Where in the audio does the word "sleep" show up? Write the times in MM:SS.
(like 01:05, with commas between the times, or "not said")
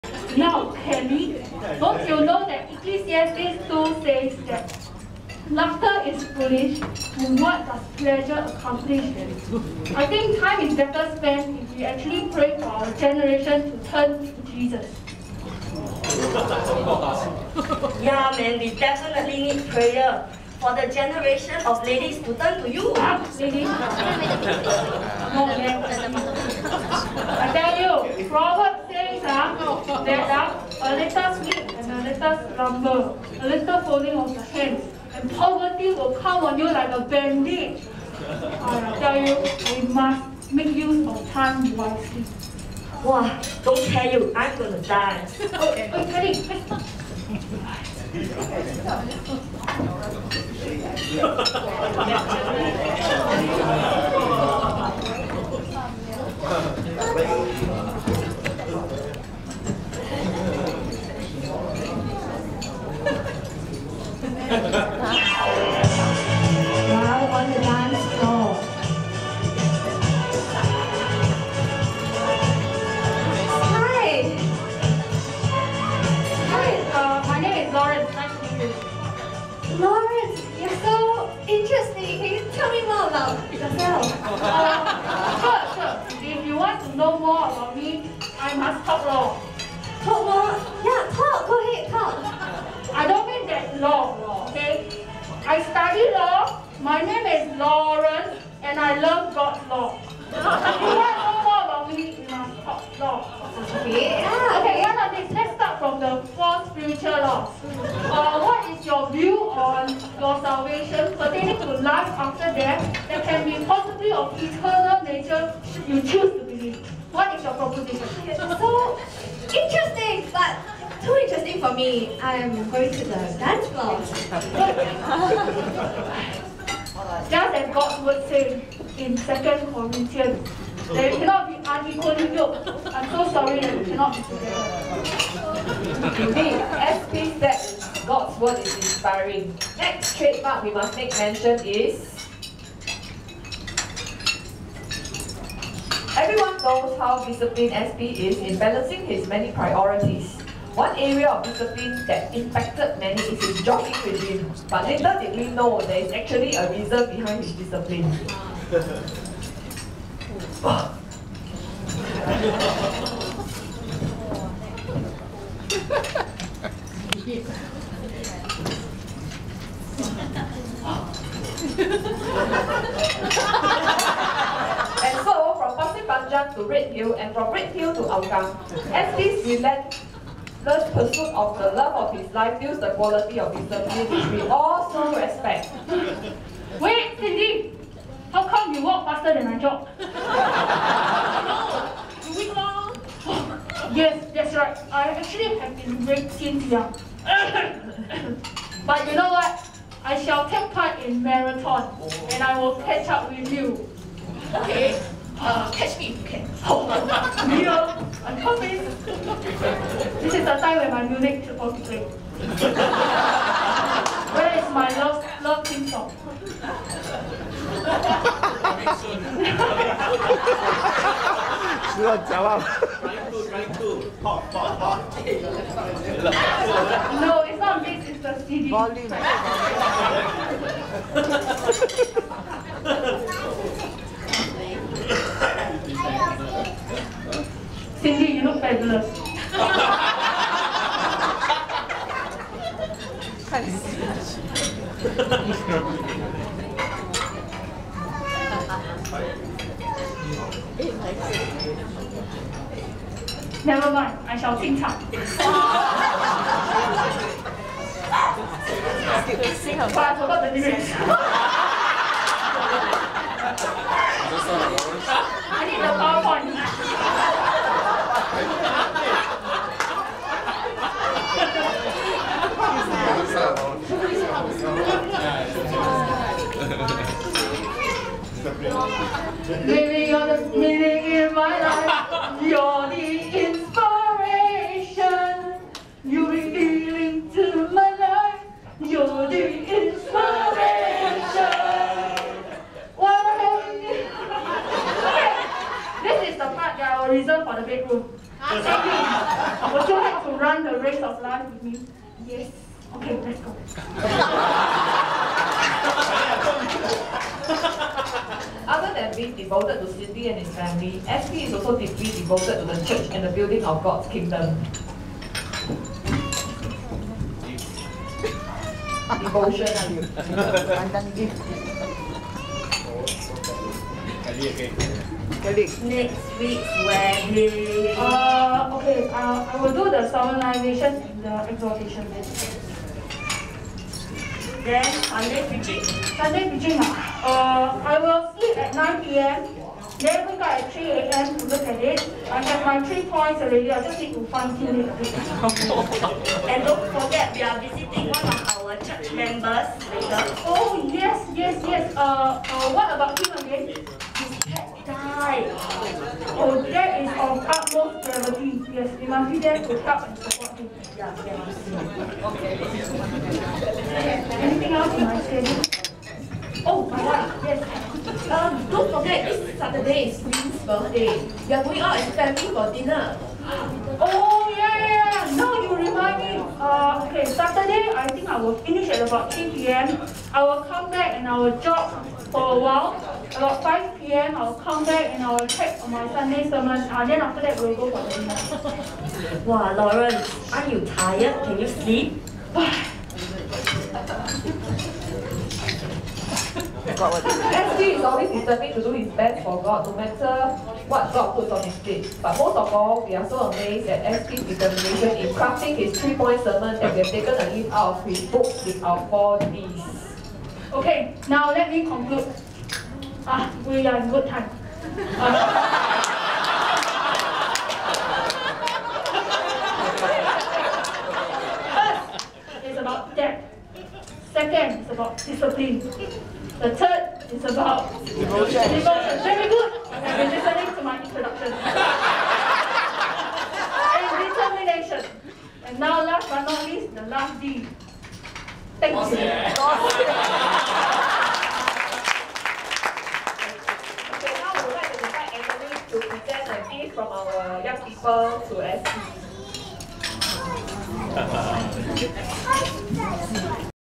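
00:31, 05:38, 06:31.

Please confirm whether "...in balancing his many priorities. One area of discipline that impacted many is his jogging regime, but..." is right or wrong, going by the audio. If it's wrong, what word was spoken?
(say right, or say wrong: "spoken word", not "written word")
right.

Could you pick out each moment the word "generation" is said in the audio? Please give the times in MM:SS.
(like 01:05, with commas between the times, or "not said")
00:12, 00:20.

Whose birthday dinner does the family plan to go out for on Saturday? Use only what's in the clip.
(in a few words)
Lynn's.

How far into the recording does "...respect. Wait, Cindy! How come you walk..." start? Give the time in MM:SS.
03:05.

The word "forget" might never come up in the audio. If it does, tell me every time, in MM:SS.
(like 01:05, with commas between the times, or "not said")
05:46, 06:08.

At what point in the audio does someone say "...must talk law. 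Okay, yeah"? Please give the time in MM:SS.
01:42.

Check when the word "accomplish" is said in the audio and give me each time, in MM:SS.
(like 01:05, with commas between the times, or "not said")
00:08.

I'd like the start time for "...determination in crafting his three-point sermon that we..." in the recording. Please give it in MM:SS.
06:44.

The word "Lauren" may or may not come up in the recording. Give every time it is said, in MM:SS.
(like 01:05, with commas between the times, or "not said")
01:37, 06:29.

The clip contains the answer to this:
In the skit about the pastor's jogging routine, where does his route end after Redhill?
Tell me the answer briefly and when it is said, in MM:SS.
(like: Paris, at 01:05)
Hougang, at 02:58.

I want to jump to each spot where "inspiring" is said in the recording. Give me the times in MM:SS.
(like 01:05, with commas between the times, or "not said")
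02:18.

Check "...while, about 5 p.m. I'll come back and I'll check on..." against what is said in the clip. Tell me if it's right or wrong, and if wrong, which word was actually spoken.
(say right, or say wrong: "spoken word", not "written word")
right.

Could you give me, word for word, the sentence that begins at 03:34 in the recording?
Where is my love, love theme song?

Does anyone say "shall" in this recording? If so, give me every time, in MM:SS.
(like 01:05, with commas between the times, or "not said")
03:20, 04:14.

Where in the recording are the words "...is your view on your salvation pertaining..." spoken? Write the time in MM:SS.
01:48.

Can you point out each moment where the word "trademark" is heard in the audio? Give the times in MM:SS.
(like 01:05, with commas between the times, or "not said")
02:20.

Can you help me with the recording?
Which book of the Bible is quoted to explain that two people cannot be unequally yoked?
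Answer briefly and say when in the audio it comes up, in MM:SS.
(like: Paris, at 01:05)
Second Corinthians, at 02:09.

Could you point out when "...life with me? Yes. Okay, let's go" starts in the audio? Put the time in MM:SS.
05:01.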